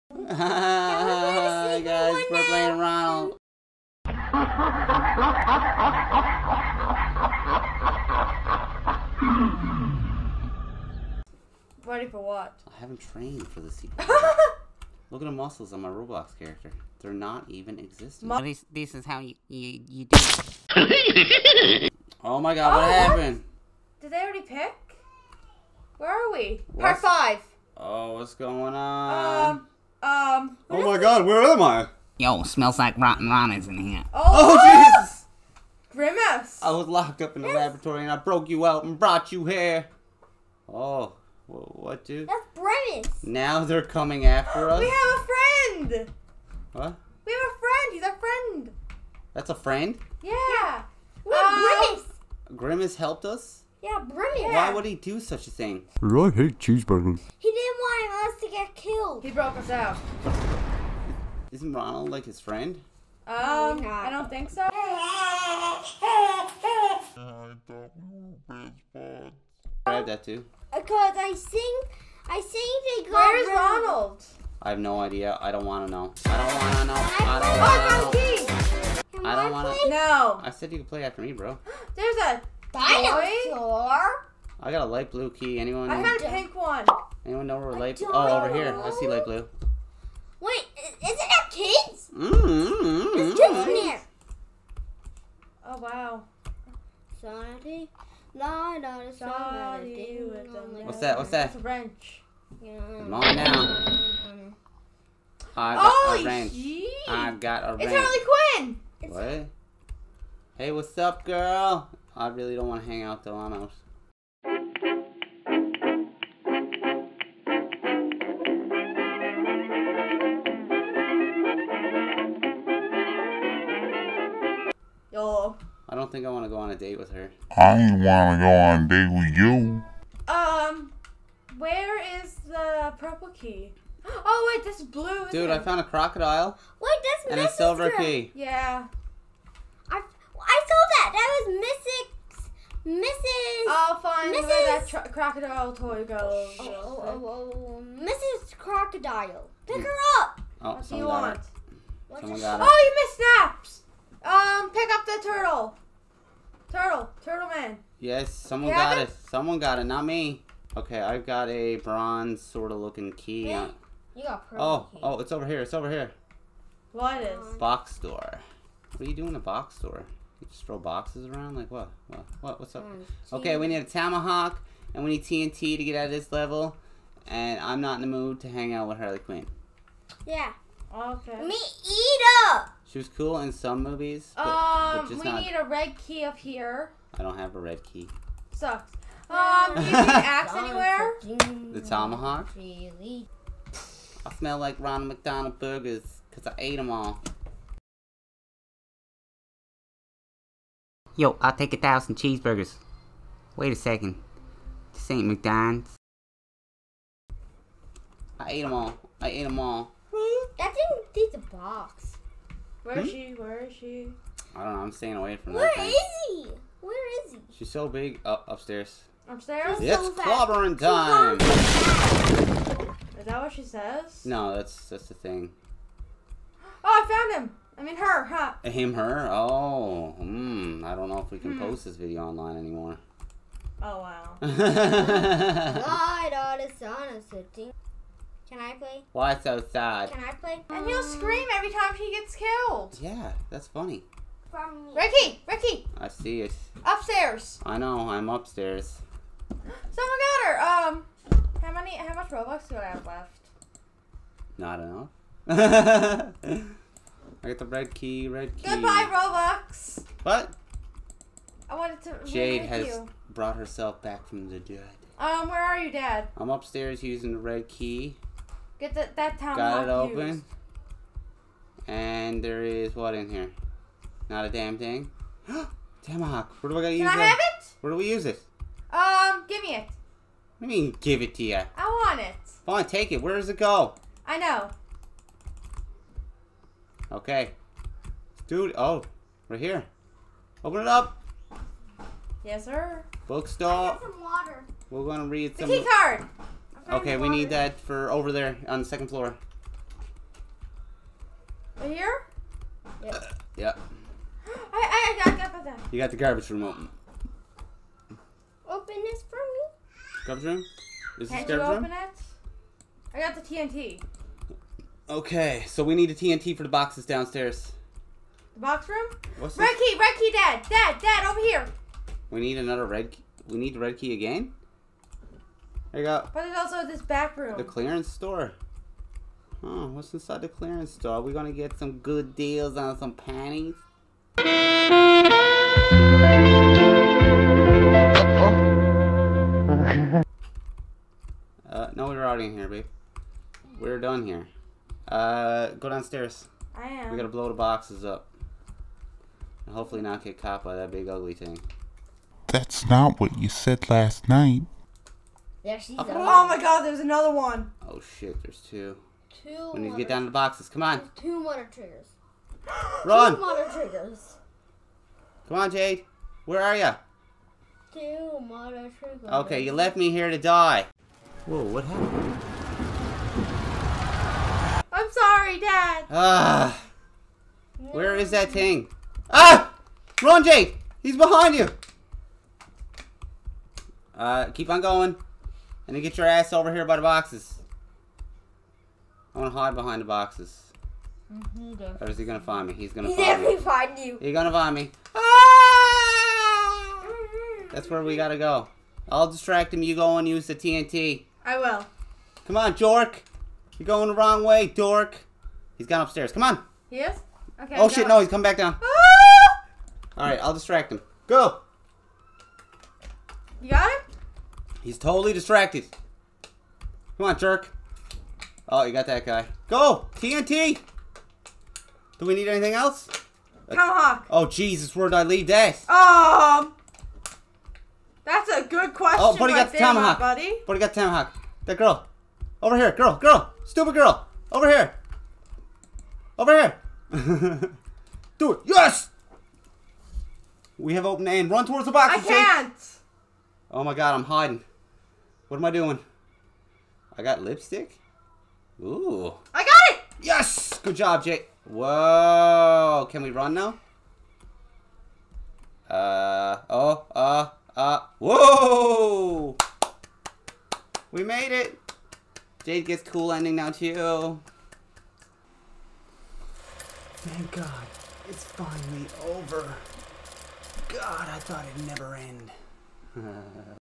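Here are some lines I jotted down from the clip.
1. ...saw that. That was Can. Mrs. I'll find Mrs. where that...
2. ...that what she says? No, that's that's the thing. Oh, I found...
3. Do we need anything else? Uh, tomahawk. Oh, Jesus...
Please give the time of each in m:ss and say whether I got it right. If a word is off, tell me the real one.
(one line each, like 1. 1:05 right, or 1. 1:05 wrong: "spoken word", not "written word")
1. 2:20 wrong: "Mrs", not "Can"
2. 3:43 right
3. 7:02 right.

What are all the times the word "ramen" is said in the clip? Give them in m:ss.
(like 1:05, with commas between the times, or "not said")
0:33.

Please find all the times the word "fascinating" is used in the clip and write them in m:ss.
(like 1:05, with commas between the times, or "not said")
not said.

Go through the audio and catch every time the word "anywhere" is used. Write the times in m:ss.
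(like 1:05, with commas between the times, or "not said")
3:10.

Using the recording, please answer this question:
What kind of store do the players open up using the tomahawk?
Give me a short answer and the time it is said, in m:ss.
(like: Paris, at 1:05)
Bookstore, at 4:53.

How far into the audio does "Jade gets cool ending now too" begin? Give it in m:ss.
7:42.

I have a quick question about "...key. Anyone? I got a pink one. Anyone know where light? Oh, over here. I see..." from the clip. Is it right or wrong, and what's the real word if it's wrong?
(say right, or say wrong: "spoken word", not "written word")
right.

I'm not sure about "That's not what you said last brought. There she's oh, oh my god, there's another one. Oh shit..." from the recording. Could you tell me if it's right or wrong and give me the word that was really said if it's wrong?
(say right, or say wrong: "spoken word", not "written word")
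wrong: "night", not "brought".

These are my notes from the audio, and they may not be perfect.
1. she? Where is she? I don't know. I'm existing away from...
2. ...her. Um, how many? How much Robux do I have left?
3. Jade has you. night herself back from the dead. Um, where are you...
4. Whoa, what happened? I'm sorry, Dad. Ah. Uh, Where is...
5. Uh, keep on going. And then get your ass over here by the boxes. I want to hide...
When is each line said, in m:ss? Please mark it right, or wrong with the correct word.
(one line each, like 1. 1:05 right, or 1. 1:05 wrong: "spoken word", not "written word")
1. 3:33 wrong: "staying", not "existing"
2. 4:10 right
3. 4:22 wrong: "brought", not "night"
4. 6:11 right
5. 6:24 right.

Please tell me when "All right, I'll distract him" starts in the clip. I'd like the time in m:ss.
6:50.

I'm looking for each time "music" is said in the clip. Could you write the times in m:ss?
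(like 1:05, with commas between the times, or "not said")
not said.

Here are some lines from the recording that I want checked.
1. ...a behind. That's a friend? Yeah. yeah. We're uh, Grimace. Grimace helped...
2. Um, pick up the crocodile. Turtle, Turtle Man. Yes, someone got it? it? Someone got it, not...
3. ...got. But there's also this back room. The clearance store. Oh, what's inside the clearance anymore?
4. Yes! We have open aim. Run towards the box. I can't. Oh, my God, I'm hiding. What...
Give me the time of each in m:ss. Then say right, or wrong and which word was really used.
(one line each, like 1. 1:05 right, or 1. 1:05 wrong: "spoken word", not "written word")
1. 0:48 wrong: "friend", not "behind"
2. 2:34 wrong: "turtle", not "crocodile"
3. 5:26 wrong: "store", not "anymore"
4. 7:18 right.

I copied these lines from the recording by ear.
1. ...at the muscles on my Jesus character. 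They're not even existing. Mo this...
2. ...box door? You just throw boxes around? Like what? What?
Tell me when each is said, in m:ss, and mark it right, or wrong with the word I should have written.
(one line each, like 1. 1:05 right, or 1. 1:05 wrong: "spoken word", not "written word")
1. 0:15 wrong: "Roblox", not "Jesus"
2. 2:49 right.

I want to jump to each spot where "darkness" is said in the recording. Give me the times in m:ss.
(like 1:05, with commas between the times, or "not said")
not said.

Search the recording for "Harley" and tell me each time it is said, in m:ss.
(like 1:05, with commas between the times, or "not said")
1:47, 2:58.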